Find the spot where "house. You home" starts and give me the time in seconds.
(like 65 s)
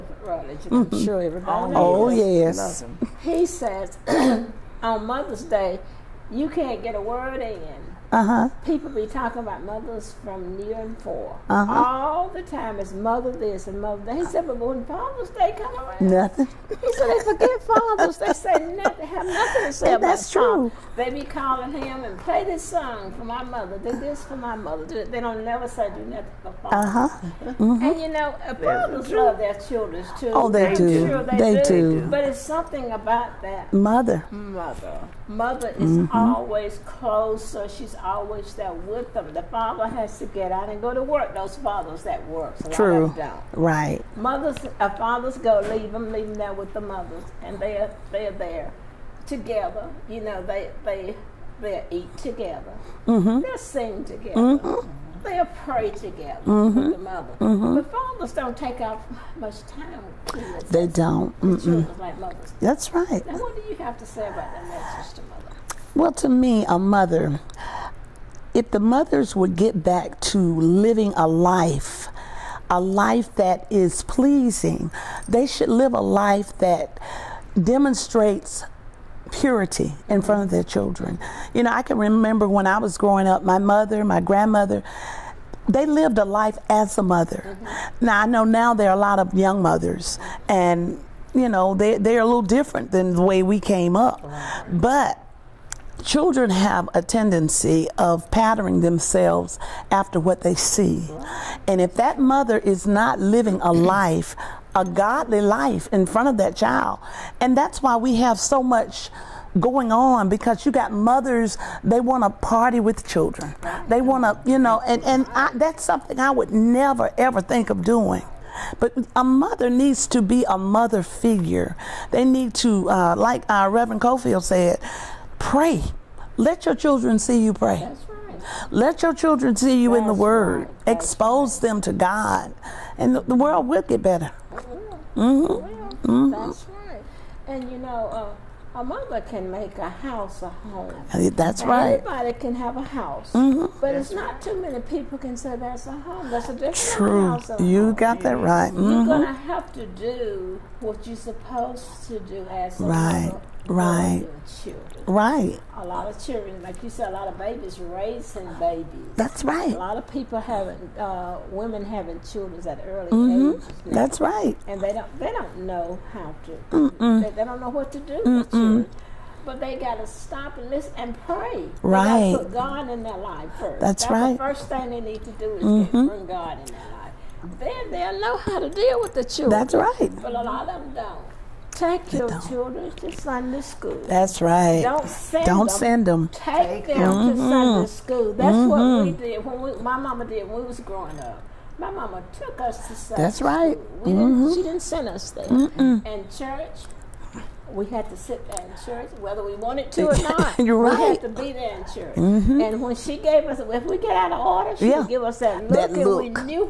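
147 s.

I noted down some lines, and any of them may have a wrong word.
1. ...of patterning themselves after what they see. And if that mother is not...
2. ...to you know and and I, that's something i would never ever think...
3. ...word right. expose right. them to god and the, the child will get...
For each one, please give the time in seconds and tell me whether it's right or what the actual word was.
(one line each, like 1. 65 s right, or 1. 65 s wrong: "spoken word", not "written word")
1. 97 s right
2. 114 s right
3. 130 s wrong: "world", not "child".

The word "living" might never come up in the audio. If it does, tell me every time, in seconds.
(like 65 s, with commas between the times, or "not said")
70 s, 103 s.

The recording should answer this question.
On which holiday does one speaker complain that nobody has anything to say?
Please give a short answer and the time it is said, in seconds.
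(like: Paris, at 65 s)
Father's Day, at 14 s.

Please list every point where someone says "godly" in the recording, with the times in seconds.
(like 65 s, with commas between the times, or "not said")
104 s.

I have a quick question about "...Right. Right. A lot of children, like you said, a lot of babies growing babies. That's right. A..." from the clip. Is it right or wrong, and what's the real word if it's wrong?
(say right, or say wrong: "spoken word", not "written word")
wrong: "raising", not "growing".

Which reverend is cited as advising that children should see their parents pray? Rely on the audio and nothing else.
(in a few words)
Reverend Cofield.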